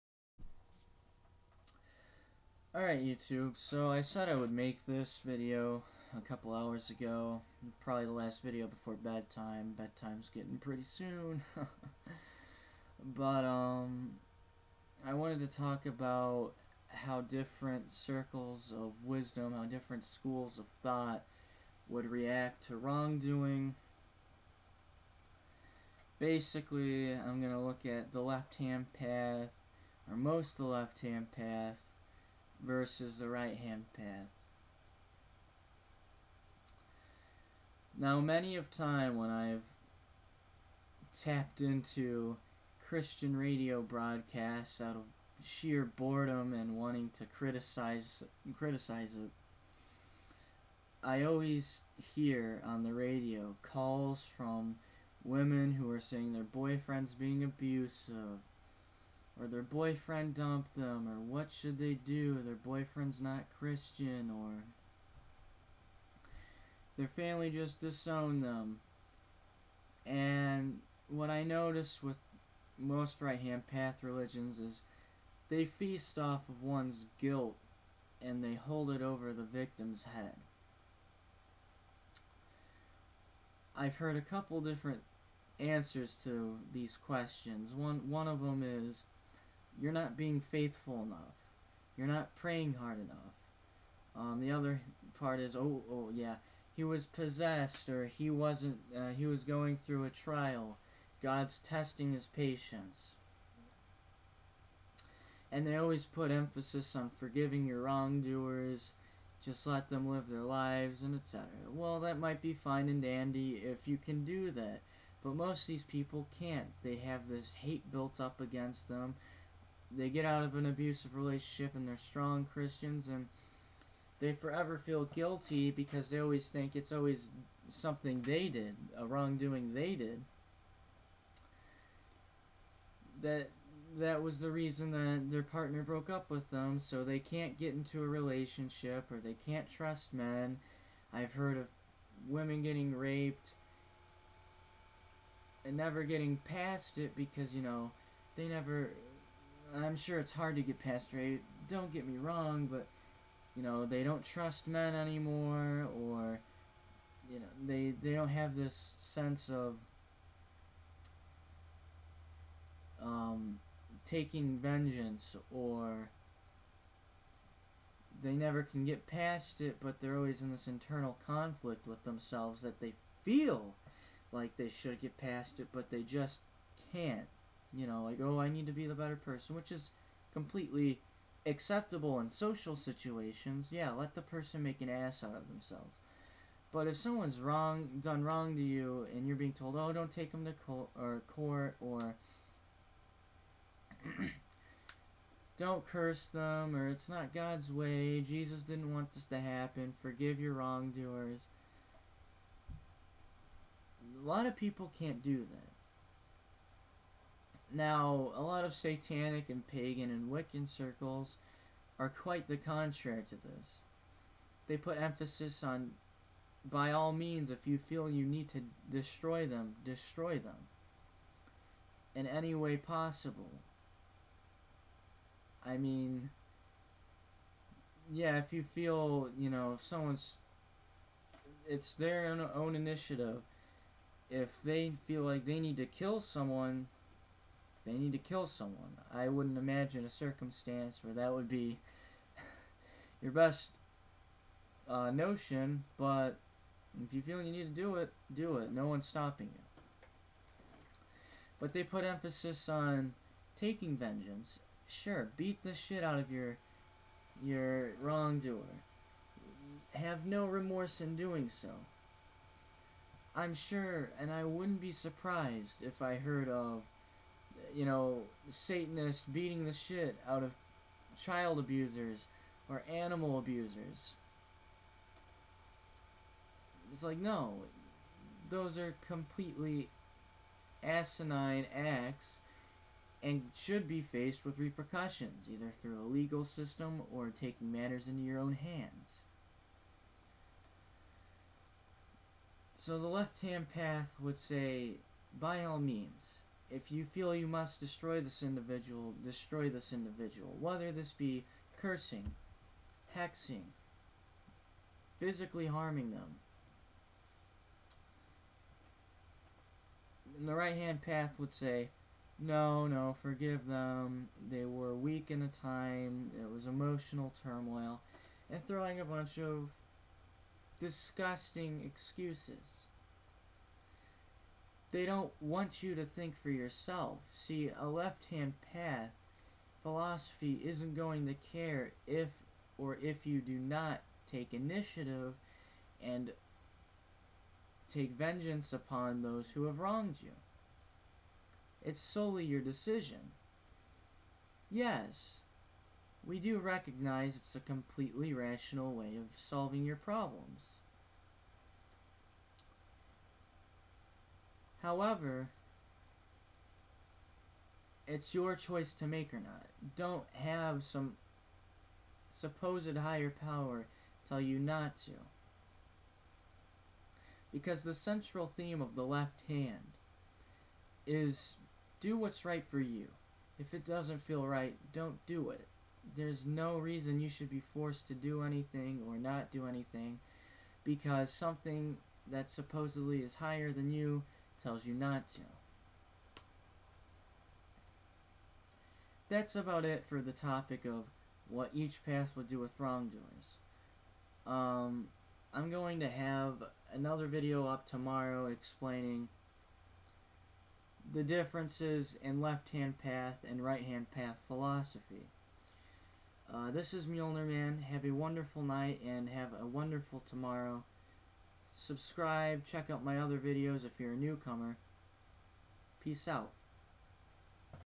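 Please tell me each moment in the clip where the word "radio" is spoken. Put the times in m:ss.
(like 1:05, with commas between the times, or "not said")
0:43, 0:52.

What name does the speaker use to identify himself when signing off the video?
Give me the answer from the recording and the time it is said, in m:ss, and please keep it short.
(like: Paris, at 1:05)
Mjollnir Man, at 6:47.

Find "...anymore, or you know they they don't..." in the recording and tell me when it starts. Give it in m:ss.
2:34.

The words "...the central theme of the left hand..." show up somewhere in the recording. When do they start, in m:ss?
6:07.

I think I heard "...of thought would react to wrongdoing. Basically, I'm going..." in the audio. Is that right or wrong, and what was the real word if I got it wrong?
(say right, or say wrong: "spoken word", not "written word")
right.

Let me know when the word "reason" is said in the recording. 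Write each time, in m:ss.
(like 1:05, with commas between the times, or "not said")
2:14, 6:16.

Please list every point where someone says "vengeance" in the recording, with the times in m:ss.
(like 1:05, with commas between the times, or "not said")
2:44, 4:13, 5:38.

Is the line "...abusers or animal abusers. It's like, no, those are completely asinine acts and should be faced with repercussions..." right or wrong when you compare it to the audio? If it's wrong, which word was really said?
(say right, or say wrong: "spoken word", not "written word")
right.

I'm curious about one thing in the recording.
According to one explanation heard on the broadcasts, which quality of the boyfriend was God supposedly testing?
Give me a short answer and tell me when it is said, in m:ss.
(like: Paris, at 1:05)
patience, at 1:42.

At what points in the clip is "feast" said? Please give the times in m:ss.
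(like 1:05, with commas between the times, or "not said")
1:15.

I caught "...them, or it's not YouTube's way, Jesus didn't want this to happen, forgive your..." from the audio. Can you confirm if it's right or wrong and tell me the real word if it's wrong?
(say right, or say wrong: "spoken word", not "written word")
wrong: "God", not "YouTube".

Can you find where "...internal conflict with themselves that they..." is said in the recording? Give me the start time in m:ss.
2:50.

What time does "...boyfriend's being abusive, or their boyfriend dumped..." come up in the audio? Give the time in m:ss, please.
0:56.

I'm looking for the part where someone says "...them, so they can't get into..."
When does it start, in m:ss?
2:16.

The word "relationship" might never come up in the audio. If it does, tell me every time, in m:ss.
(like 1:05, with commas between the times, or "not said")
2:01, 2:18.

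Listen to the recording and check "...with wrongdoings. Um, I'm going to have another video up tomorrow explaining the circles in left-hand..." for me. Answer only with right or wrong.
wrong.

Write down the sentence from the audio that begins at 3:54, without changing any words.
If they feel like they need to kill someone, they need to kill someone.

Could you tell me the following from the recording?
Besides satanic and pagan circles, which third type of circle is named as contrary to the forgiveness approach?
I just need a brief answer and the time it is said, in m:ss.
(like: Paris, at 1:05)
Wiccan, at 3:30.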